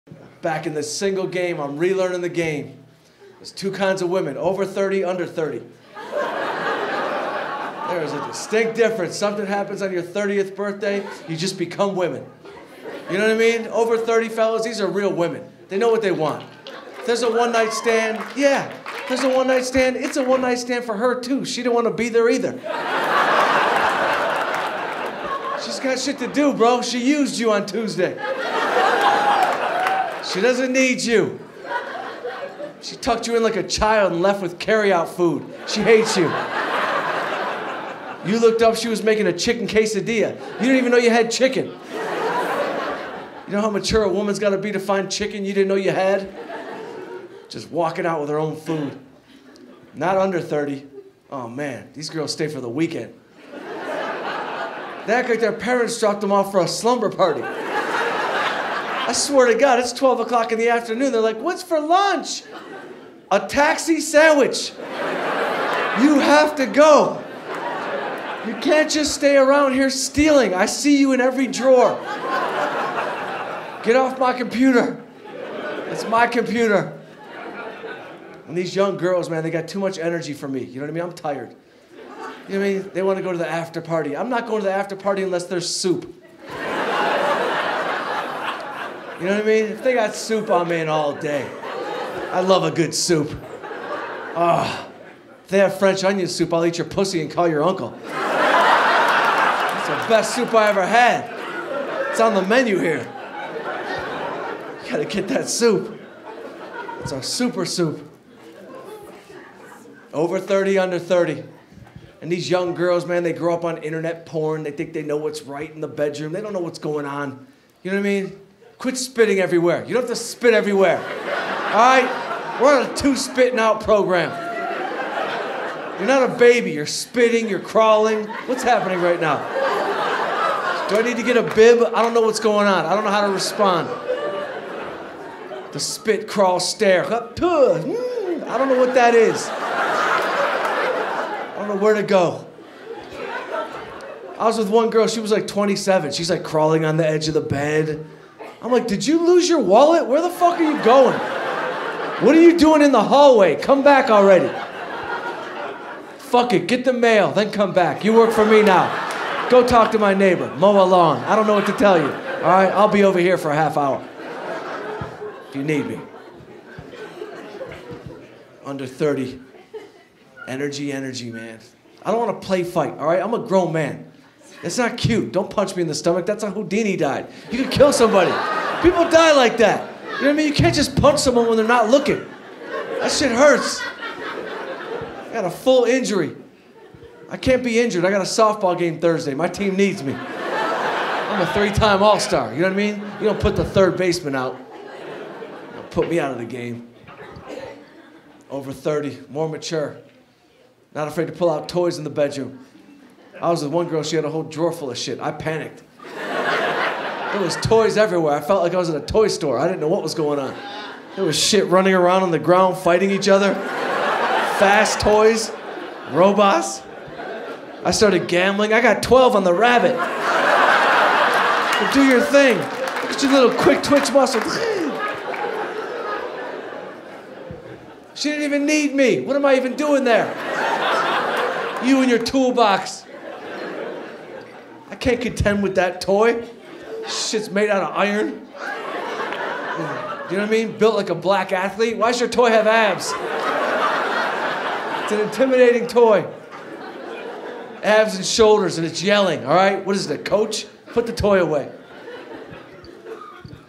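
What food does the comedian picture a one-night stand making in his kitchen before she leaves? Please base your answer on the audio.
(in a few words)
Chicken quesadilla.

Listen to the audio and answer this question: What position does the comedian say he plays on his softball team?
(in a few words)
Third baseman.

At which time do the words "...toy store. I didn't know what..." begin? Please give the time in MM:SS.
03:29.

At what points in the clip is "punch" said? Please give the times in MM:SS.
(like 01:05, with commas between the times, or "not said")
02:55, 03:00.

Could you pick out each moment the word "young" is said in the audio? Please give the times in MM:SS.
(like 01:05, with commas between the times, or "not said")
01:18, 01:52.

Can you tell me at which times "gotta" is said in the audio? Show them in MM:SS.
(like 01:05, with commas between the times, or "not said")
00:44, 01:44.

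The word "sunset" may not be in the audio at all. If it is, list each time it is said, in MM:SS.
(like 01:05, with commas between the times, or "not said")
not said.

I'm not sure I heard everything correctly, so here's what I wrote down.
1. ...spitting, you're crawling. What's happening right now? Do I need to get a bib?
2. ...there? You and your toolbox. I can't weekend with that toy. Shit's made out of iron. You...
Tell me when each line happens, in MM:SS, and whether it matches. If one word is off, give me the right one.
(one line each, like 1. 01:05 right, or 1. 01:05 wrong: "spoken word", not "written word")
1. 02:06 right
2. 03:50 wrong: "contend", not "weekend".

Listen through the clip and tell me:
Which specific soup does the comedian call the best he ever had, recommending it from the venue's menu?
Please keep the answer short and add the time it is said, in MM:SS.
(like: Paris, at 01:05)
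French onion soup, at 01:35.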